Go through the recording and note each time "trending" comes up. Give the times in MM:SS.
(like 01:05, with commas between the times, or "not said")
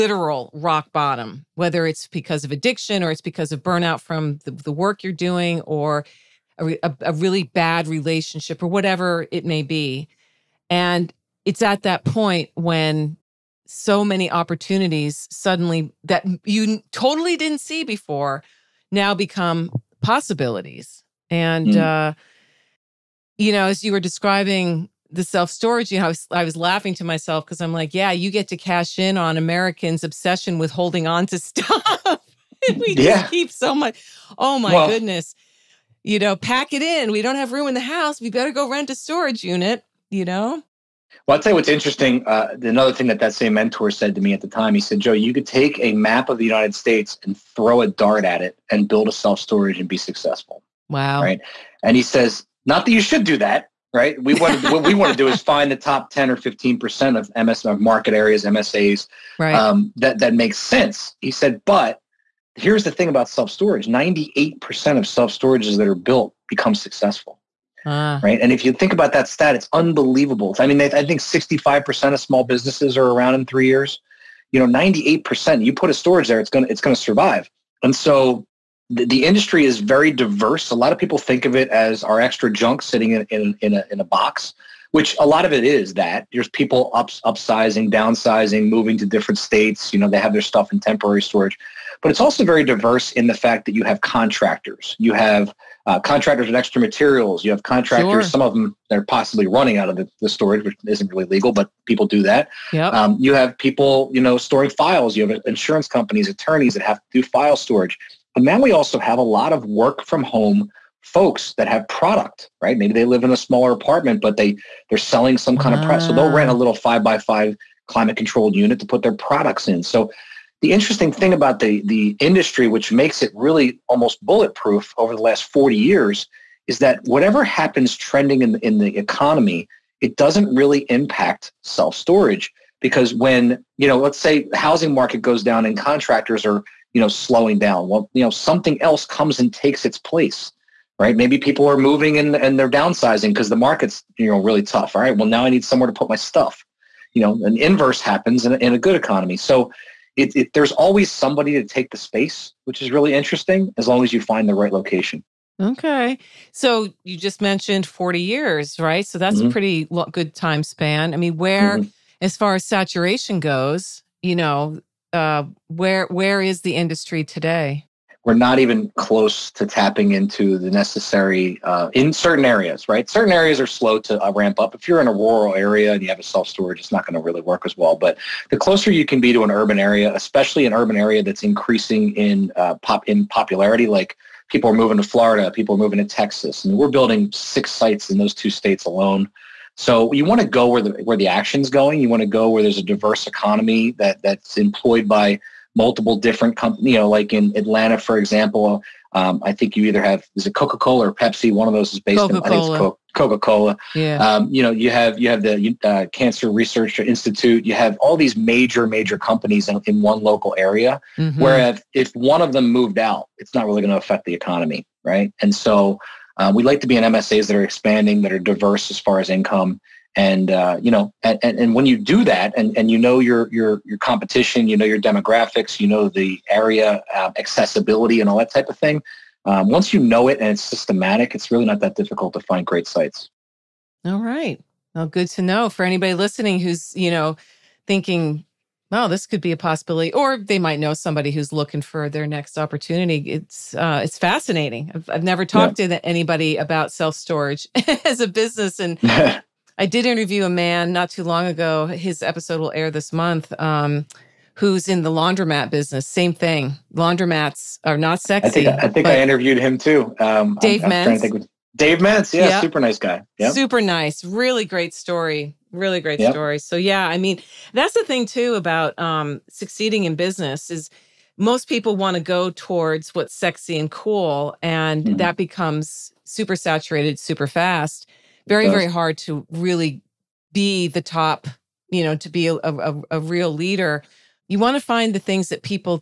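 02:07.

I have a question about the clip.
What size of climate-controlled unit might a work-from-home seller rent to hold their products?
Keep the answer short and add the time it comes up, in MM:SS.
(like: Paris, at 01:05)
five by five, at 01:56.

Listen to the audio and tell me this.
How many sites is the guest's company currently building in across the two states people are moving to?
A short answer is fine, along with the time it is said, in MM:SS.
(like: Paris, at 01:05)
6, at 03:07.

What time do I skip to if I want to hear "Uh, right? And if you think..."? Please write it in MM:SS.
01:07.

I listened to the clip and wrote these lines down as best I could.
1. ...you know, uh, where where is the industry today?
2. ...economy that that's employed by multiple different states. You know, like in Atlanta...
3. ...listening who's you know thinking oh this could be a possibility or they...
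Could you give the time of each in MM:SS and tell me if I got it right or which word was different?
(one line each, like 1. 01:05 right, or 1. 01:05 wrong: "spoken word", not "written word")
1. 02:44 right
2. 03:13 wrong: "companies", not "states"
3. 03:56 right.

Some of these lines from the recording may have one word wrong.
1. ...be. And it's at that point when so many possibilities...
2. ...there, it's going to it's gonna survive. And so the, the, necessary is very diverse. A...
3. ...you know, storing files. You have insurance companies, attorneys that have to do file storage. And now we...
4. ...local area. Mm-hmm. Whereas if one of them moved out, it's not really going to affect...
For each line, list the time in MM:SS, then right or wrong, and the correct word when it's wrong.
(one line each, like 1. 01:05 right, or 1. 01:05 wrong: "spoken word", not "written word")
1. 00:09 wrong: "opportunities", not "possibilities"
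2. 01:16 wrong: "industry", not "necessary"
3. 01:44 right
4. 03:30 right.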